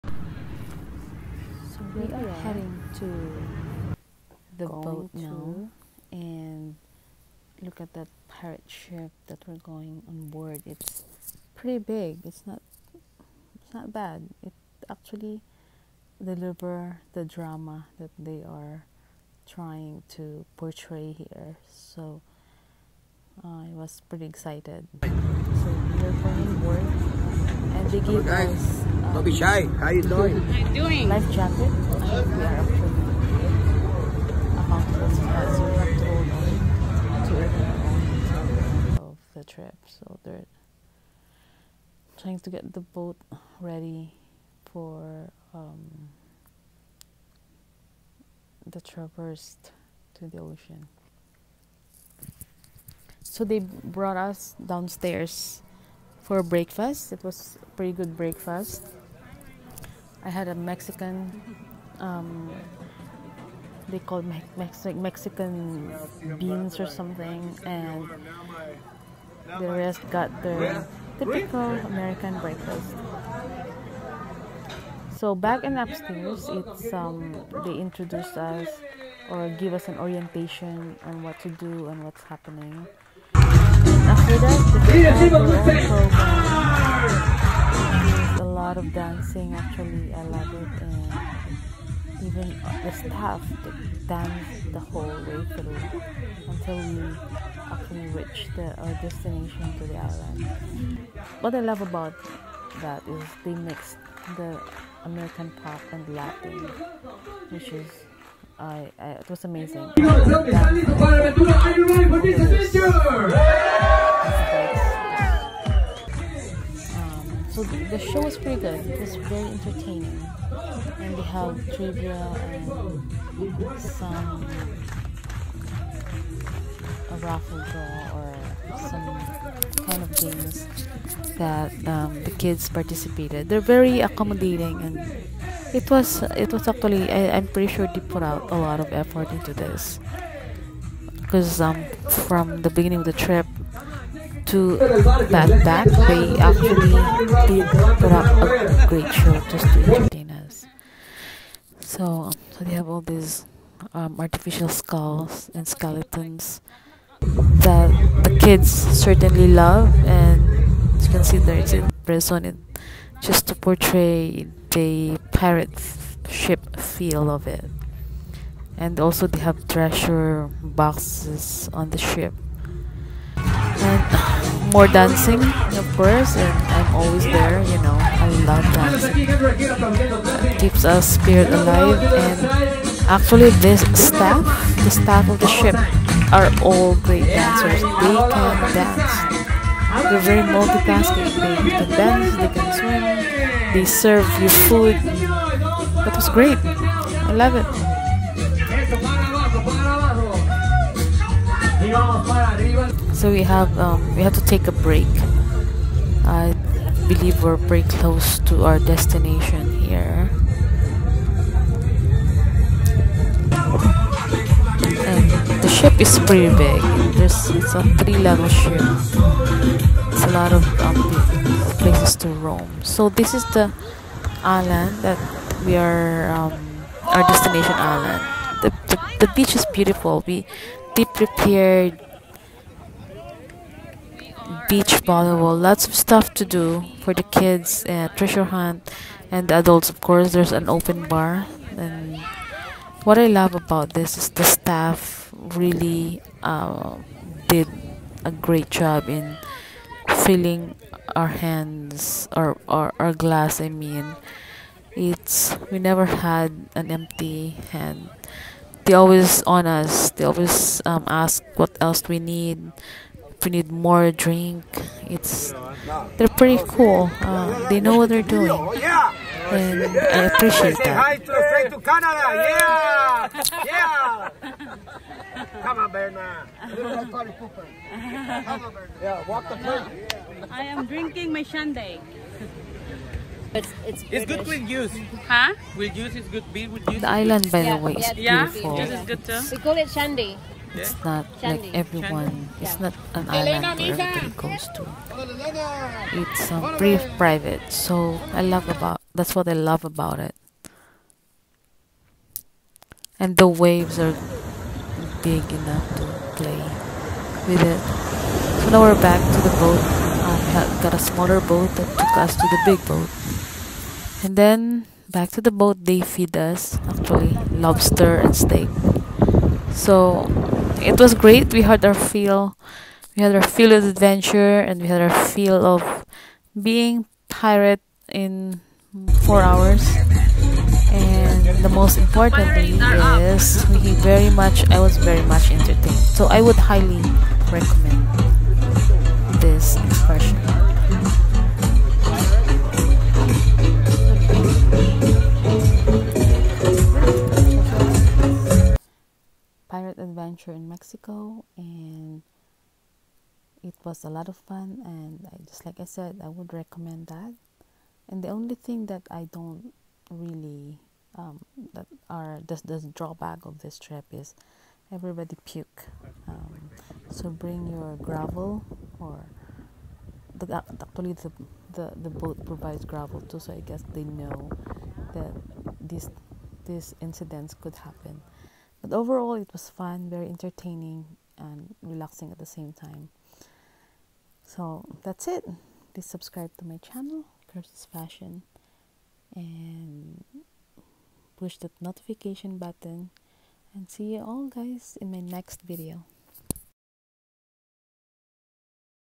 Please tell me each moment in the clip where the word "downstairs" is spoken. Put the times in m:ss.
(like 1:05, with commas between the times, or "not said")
0:54.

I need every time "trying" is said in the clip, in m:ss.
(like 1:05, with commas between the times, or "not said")
0:19, 0:42.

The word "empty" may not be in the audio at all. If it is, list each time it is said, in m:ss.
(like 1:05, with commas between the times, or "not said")
4:16.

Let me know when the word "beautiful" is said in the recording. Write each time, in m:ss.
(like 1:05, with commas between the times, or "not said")
3:49, 4:48.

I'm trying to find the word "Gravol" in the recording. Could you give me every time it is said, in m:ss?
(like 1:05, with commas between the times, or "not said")
6:07, 6:12.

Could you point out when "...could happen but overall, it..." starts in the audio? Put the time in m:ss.
6:17.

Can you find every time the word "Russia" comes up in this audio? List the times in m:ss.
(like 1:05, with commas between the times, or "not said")
not said.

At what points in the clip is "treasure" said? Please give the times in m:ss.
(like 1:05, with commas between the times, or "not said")
2:49, 3:58.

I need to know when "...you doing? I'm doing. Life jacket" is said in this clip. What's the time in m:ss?
0:29.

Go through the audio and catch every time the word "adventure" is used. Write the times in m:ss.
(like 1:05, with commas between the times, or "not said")
5:23, 5:50.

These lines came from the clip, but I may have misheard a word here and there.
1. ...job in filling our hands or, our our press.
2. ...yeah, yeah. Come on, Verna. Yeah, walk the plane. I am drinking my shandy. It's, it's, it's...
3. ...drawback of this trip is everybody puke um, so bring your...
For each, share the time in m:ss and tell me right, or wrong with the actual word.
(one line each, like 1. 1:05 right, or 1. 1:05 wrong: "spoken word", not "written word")
1. 4:08 wrong: "glass", not "press"
2. 4:32 right
3. 6:02 right.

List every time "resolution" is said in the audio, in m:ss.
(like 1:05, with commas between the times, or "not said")
not said.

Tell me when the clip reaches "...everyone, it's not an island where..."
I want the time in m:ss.
4:51.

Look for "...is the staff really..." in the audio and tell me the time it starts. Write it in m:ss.
4:04.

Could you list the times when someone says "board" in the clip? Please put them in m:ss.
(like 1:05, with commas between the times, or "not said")
0:10, 0:26.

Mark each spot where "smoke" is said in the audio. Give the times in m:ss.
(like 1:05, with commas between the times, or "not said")
not said.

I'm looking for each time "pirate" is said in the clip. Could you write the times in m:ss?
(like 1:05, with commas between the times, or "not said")
0:08, 2:45, 5:27, 5:49.